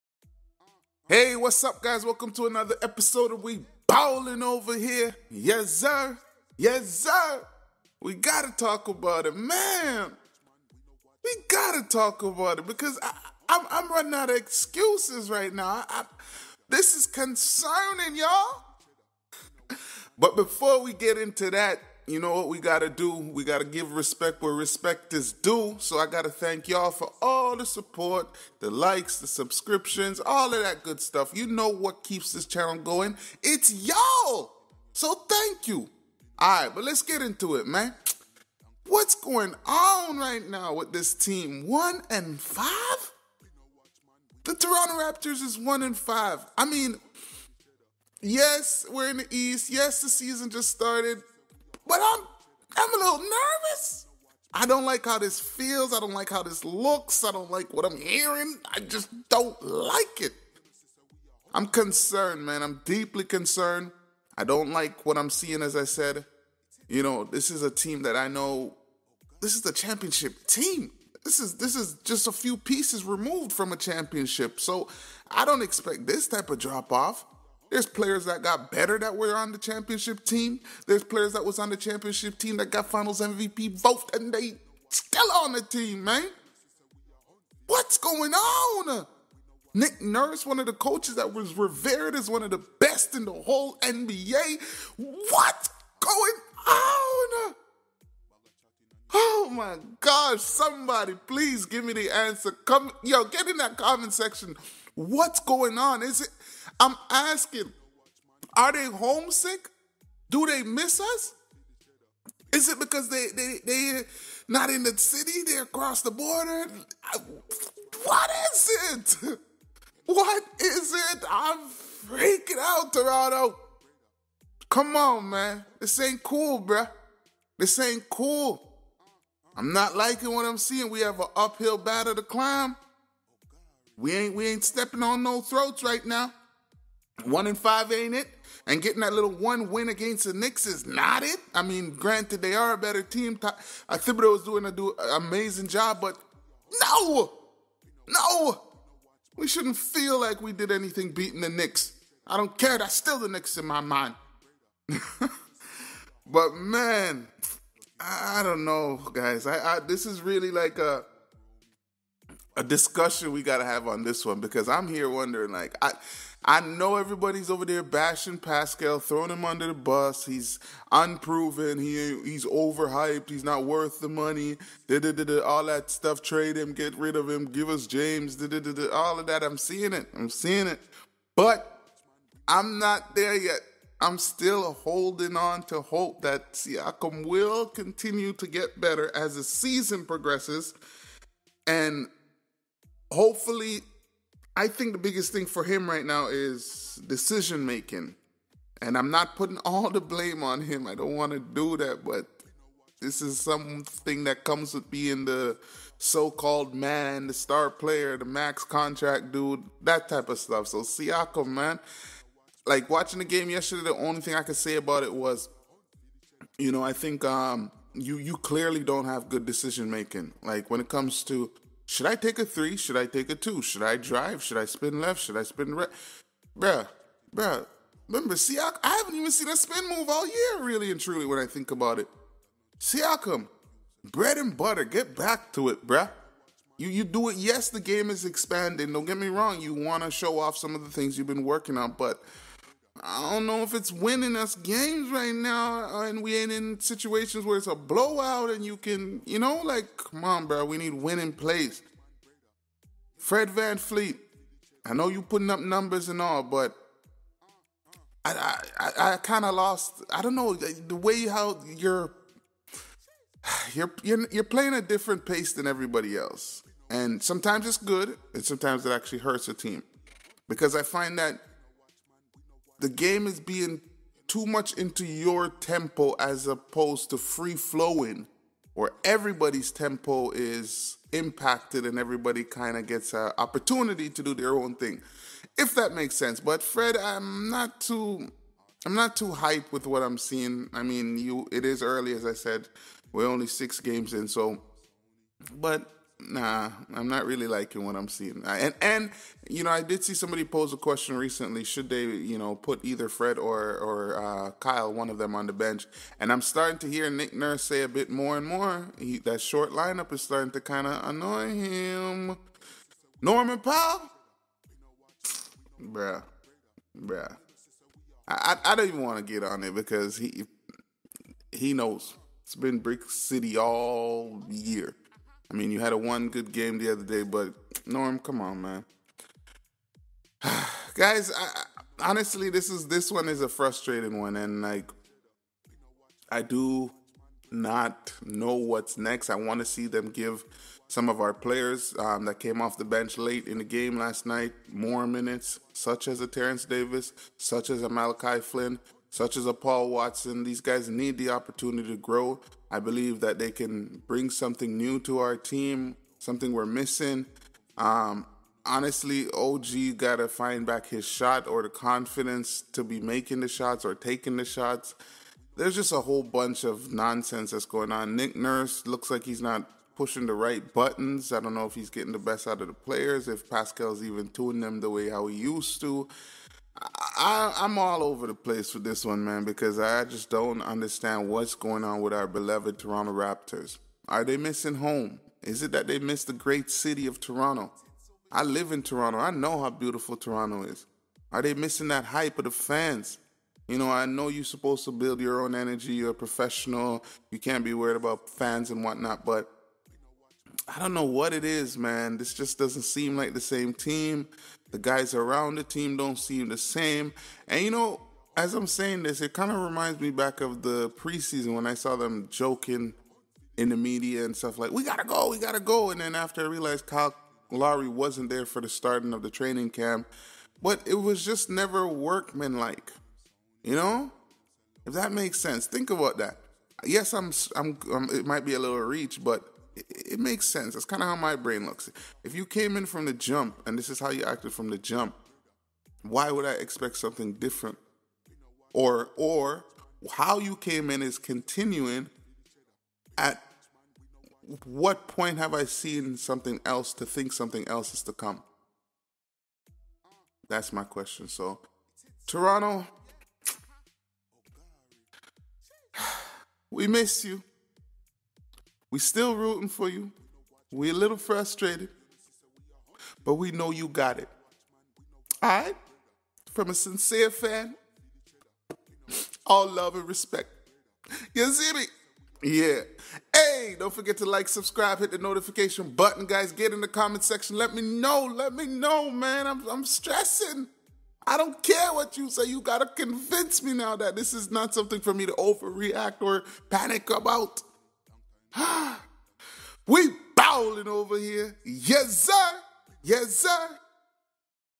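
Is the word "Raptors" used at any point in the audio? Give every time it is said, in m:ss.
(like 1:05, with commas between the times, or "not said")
0:44, 6:23.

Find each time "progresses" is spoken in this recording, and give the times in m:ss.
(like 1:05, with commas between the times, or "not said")
3:10.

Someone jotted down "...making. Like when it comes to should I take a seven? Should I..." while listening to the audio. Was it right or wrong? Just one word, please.
wrong.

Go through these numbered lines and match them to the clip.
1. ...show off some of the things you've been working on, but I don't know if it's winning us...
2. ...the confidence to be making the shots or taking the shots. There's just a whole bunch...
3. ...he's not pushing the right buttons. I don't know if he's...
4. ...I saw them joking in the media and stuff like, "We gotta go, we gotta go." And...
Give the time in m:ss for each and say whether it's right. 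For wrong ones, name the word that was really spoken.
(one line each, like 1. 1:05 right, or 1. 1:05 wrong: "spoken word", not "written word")
1. 4:00 right
2. 6:01 right
3. 6:09 right
4. 6:51 right.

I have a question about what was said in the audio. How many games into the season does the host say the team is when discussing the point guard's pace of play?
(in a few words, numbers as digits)
6.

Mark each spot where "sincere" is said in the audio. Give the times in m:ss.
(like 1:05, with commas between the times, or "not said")
7:46.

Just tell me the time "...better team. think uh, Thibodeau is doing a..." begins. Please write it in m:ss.
2:22.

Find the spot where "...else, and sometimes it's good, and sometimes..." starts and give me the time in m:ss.
4:26.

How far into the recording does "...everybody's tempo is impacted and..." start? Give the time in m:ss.
4:39.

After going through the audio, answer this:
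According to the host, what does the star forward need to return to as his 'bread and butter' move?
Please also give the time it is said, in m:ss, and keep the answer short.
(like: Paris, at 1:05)
Spin move, at 3:49.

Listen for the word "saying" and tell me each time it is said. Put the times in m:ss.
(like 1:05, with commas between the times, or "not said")
6:48.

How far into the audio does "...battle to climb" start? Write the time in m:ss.
2:11.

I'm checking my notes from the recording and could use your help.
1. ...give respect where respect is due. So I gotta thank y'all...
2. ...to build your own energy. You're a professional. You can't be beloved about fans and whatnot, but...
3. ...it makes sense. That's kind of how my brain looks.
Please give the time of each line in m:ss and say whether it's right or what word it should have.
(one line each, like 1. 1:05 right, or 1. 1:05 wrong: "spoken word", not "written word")
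1. 0:23 right
2. 6:34 wrong: "worried", not "beloved"
3. 7:10 right.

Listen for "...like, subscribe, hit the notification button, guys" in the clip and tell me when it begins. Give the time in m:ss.
7:54.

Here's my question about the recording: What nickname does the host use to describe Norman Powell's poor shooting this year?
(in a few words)
Brick City.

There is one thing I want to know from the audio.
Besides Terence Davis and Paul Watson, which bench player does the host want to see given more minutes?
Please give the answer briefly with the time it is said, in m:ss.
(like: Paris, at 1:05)
Malachi Flynn, at 5:47.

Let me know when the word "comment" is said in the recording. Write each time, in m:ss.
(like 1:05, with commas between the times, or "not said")
1:43, 7:56.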